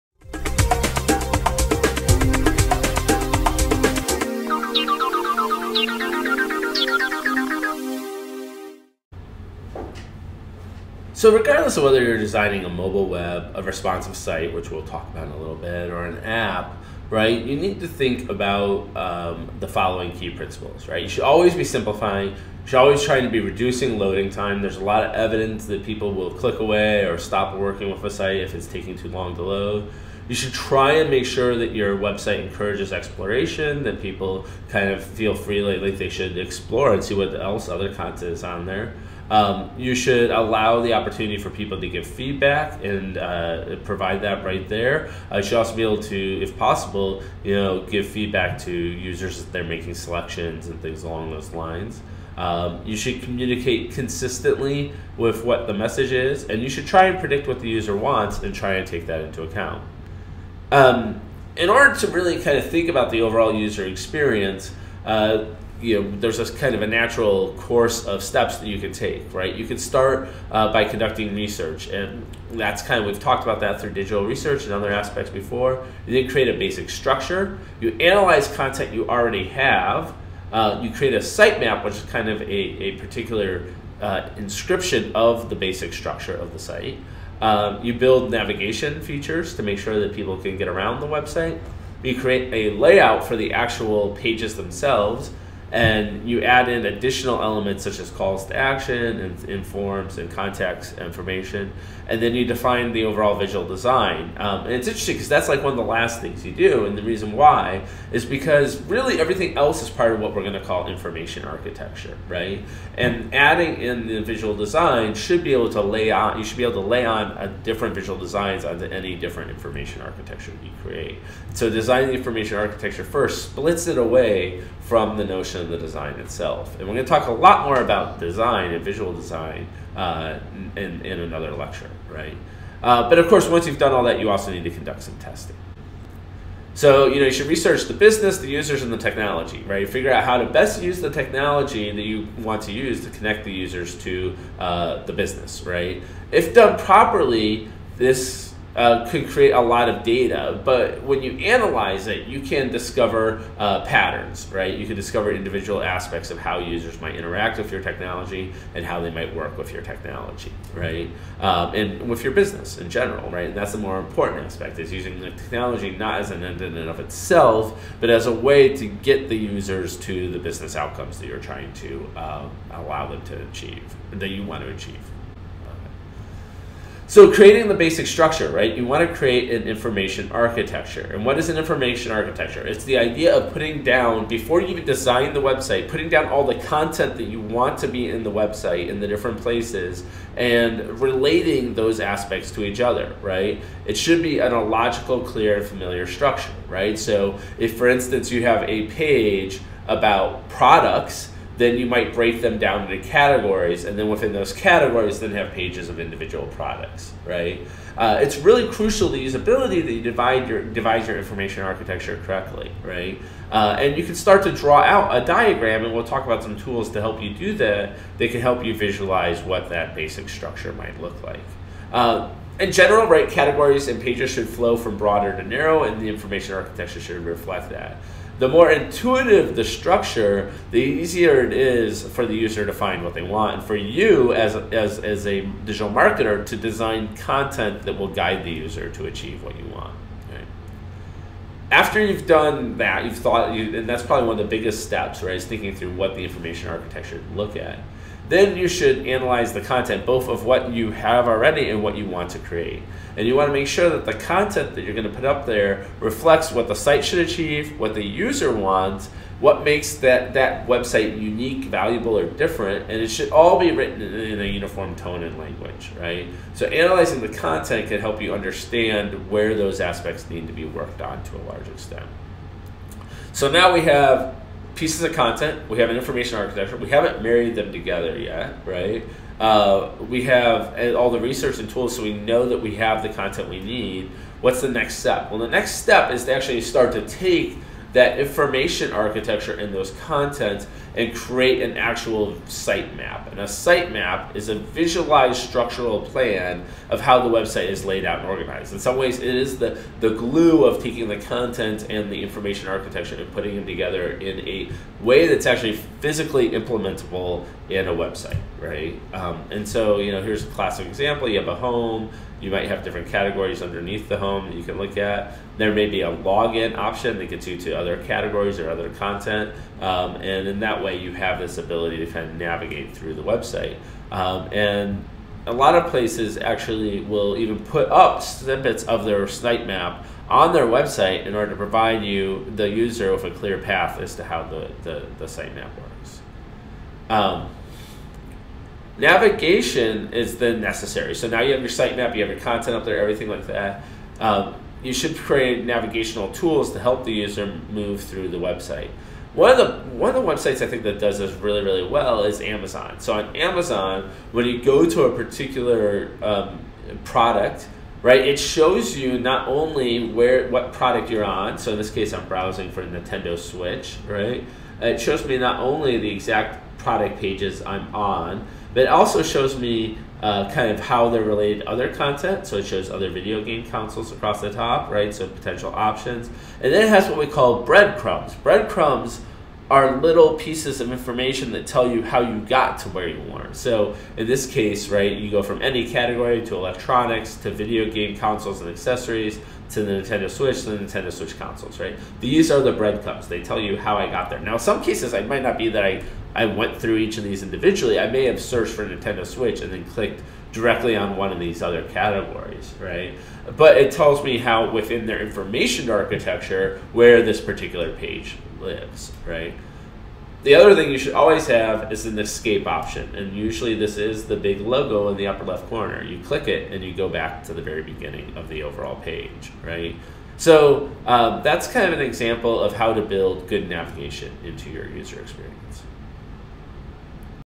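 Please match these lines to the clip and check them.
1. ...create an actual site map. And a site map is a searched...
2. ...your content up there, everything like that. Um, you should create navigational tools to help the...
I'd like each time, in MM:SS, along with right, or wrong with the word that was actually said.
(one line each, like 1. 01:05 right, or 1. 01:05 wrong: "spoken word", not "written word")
1. 04:51 wrong: "visualized", not "searched"
2. 05:42 right.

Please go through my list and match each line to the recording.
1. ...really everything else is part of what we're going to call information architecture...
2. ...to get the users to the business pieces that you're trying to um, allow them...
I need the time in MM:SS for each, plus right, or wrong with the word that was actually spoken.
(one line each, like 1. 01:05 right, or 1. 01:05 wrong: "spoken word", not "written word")
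1. 01:48 right
2. 02:48 wrong: "outcomes", not "pieces".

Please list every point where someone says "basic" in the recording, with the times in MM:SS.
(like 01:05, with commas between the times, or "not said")
01:16, 01:25, 02:57, 03:39.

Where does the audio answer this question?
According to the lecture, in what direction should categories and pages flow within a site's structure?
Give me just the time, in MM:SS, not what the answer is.
03:44.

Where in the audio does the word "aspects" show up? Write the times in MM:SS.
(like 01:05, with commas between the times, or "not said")
01:14, 02:35, 02:44, 03:11, 04:29.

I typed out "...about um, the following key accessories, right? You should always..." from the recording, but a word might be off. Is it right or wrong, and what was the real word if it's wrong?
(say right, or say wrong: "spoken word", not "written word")
wrong: "principles", not "accessories".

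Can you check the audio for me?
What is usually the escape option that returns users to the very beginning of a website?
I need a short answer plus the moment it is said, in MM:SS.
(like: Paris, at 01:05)
the big logo, at 06:54.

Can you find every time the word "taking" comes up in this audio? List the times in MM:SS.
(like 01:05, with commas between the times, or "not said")
00:28, 05:00.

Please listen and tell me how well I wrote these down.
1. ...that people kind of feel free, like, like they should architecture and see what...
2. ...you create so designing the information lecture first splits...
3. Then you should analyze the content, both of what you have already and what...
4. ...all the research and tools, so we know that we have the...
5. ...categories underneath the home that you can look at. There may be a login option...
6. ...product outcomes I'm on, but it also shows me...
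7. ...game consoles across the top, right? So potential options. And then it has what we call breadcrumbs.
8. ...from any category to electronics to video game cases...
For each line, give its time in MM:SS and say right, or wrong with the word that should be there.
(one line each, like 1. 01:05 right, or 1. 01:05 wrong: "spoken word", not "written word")
1. 00:33 wrong: "explore", not "architecture"
2. 02:00 wrong: "architecture", not "lecture"
3. 04:08 right
4. 04:40 right
5. 05:13 right
6. 06:06 wrong: "pages", not "outcomes"
7. 06:13 right
8. 06:25 wrong: "consoles", not "cases".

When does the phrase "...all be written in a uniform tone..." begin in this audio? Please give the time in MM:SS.
04:23.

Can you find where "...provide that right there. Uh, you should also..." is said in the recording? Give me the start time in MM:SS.
00:43.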